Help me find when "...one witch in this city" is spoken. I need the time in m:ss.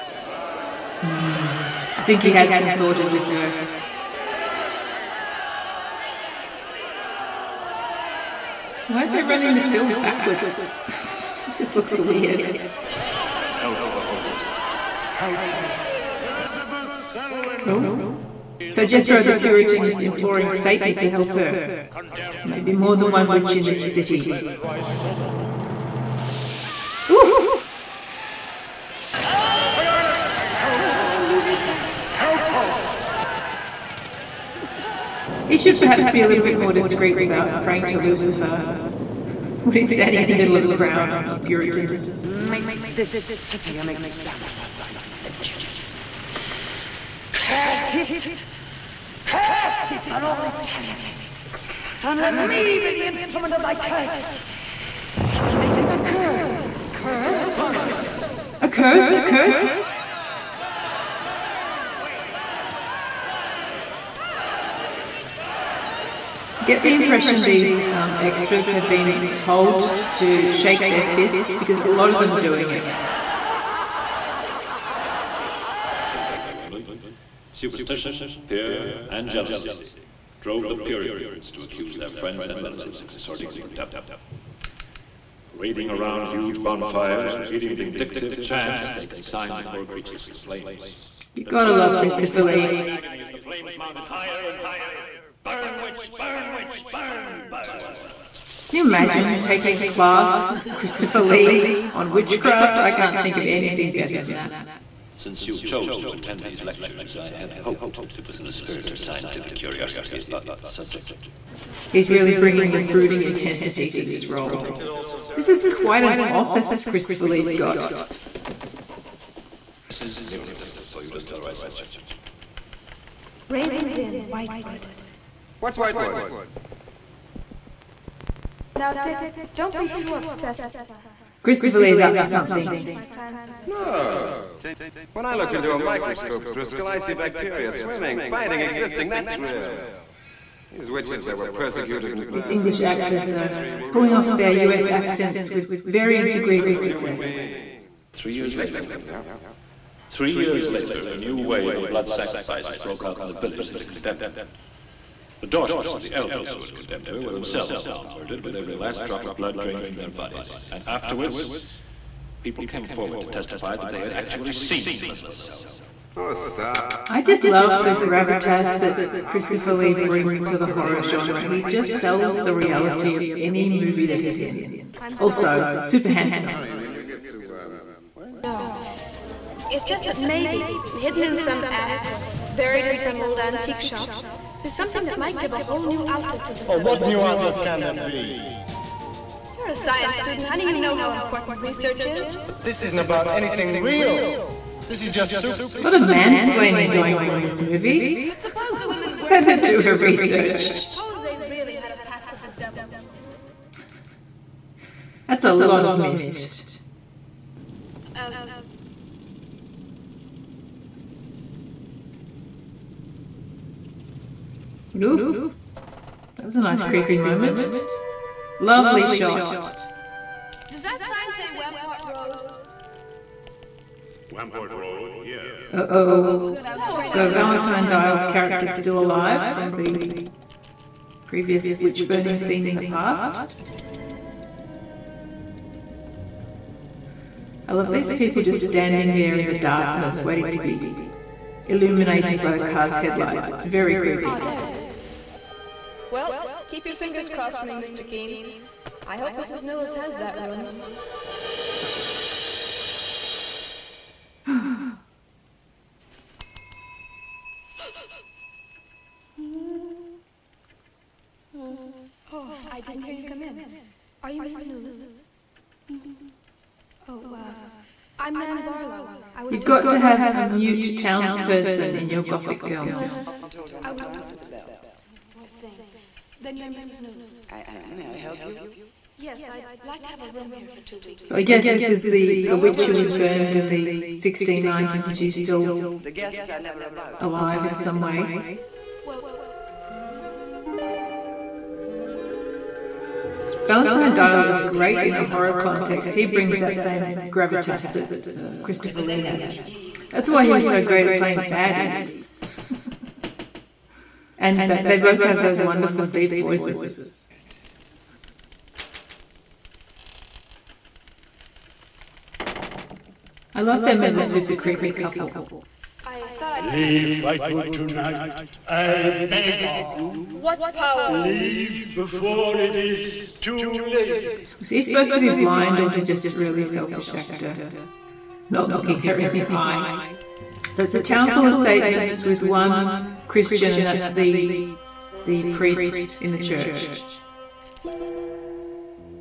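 0:23.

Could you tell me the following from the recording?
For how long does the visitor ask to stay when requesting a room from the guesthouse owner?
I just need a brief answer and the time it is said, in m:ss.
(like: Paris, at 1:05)
2 weeks, at 4:40.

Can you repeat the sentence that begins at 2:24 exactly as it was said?
accents with varying degrees of success.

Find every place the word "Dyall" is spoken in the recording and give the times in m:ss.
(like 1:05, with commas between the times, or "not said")
3:47, 4:54.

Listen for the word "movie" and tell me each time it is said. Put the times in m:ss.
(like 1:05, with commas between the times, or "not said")
2:53, 3:17.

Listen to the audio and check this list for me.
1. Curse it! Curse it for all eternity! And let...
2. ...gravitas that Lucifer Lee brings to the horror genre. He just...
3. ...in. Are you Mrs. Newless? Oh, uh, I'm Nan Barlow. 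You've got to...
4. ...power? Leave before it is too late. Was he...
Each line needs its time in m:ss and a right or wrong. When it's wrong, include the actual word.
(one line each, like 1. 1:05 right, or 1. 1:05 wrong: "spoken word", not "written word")
1. 0:47 right
2. 2:47 wrong: "Christopher", not "Lucifer"
3. 4:23 right
4. 5:20 right.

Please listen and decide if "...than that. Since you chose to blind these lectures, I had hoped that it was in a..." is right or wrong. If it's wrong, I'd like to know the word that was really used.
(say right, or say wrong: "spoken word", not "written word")
wrong: "attend", not "blind".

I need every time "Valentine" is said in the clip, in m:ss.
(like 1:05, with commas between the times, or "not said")
3:47, 4:53.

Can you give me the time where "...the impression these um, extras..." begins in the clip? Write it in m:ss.
1:06.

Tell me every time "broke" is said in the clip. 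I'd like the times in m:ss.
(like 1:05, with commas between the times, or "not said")
2:32.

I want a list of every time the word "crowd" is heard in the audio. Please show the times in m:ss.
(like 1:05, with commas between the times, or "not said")
0:40.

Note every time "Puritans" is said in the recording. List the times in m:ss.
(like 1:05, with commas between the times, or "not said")
0:19, 0:41, 1:20.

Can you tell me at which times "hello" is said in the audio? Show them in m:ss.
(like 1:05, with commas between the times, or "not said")
not said.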